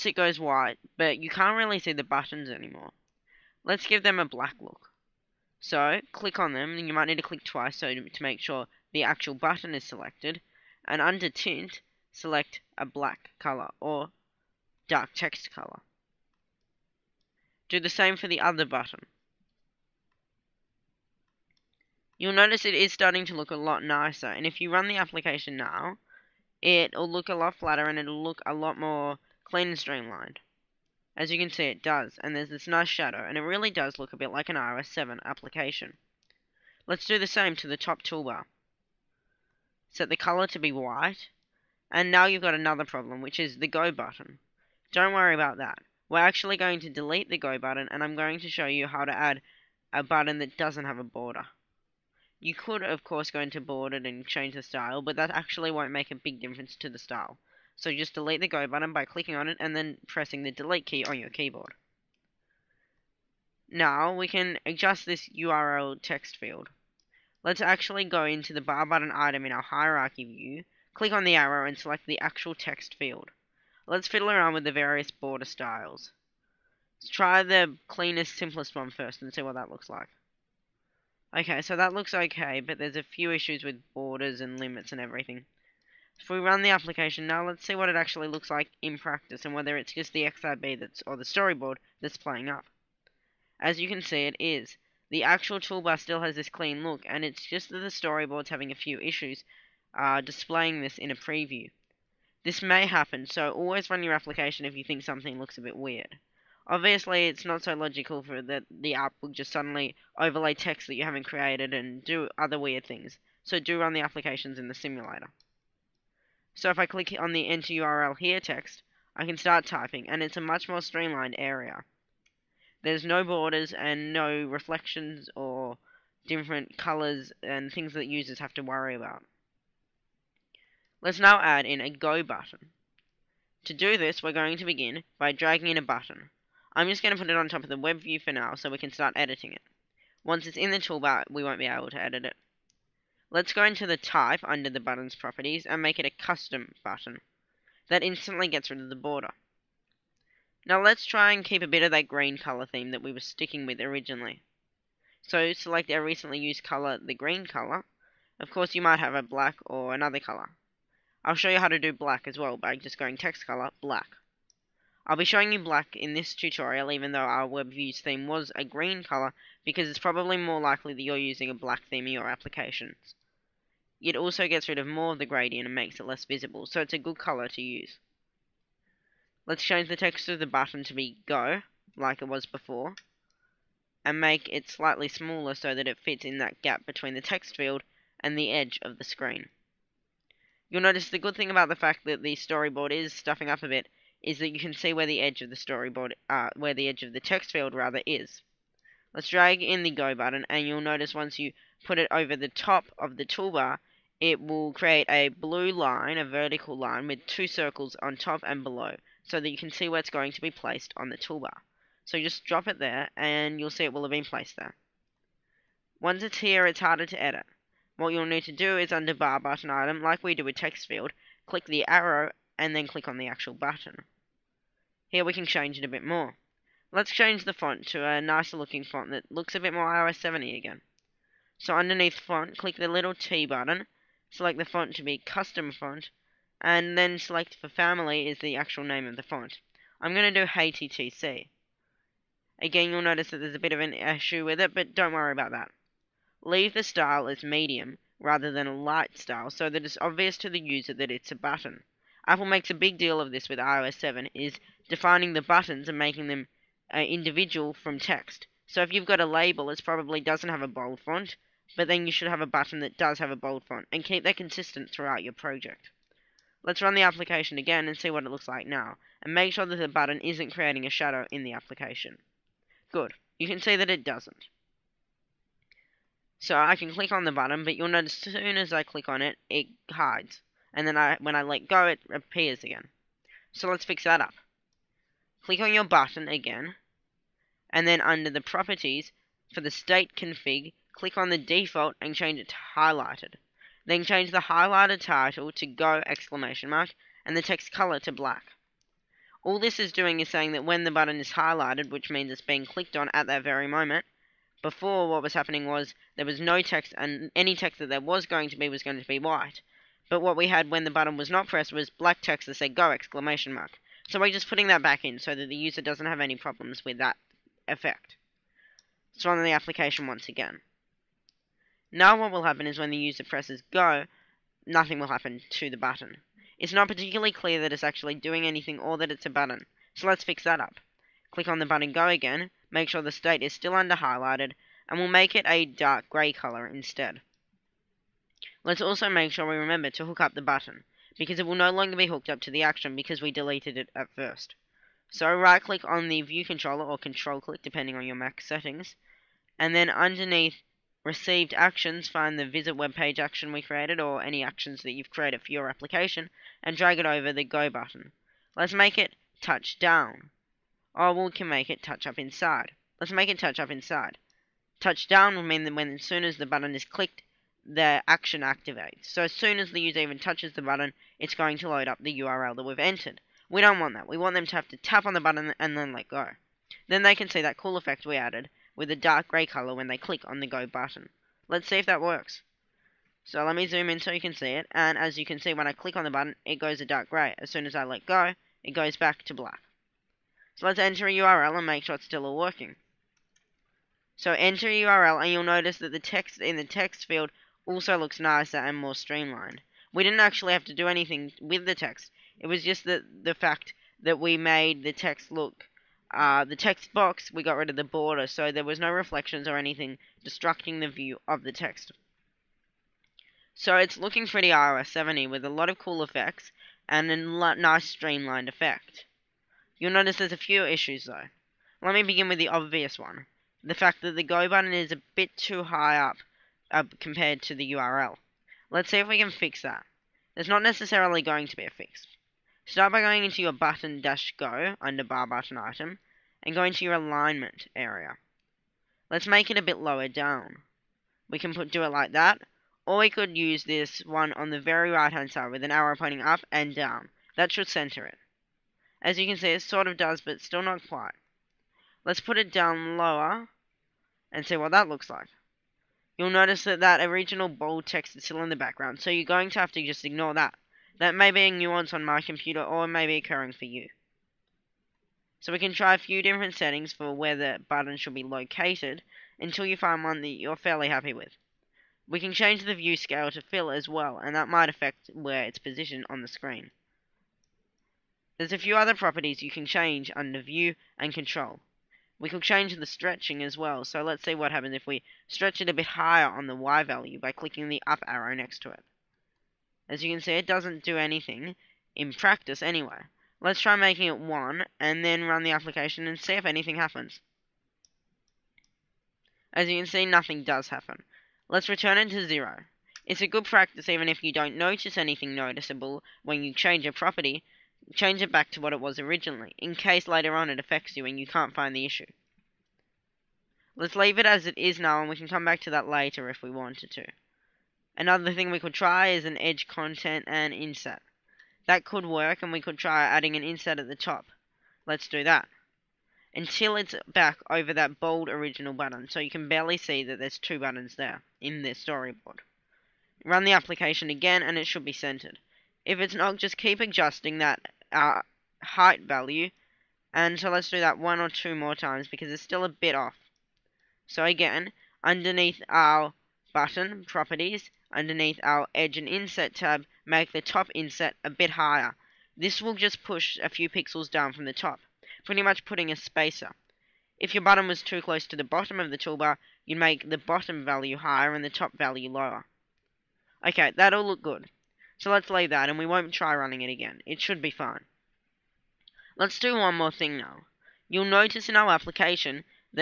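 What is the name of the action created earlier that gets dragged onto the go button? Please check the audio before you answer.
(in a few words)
Visit web page.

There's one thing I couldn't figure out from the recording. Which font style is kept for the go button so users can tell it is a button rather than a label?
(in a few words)
Medium.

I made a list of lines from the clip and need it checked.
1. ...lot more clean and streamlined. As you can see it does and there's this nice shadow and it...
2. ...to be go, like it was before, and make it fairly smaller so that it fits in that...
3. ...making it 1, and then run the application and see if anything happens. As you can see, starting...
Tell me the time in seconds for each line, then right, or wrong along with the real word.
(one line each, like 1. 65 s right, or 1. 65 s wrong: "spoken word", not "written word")
1. 28 s right
2. 180 s wrong: "slightly", not "fairly"
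3. 493 s wrong: "nothing", not "starting".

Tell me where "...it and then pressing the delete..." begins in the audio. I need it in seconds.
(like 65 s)
59 s.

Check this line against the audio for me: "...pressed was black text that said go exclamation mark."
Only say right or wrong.
right.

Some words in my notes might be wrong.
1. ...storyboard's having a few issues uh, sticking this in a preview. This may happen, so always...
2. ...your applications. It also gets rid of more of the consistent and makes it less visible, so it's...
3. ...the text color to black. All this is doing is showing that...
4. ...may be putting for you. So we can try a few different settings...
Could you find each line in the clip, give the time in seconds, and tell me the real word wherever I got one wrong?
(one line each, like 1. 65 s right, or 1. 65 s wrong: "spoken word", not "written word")
1. 97 s wrong: "displaying", not "sticking"
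2. 172 s wrong: "gradient", not "consistent"
3. 297 s wrong: "saying", not "showing"
4. 462 s wrong: "occurring", not "putting".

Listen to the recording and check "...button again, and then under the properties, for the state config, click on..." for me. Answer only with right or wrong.
right.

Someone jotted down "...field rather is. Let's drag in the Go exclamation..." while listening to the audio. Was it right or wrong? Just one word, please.
wrong.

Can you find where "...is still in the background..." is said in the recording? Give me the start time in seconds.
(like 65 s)
458 s.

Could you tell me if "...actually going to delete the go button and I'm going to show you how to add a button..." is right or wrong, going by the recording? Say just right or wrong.
right.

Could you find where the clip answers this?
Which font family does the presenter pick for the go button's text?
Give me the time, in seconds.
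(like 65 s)
240 s.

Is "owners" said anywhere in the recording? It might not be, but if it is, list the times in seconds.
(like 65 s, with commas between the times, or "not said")
not said.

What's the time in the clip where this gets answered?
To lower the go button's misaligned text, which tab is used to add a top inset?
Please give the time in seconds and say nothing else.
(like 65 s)
548 s.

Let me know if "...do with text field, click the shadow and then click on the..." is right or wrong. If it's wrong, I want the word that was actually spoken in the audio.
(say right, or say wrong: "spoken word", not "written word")
wrong: "arrow", not "shadow".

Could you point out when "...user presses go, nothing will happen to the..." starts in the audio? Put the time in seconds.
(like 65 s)
322 s.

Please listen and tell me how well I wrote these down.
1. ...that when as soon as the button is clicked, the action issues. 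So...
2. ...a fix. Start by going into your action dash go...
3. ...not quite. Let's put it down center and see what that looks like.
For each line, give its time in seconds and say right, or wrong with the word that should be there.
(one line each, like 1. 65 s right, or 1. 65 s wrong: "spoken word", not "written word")
1. 365 s wrong: "activates", not "issues"
2. 431 s wrong: "button", not "action"
3. 450 s wrong: "lower", not "center".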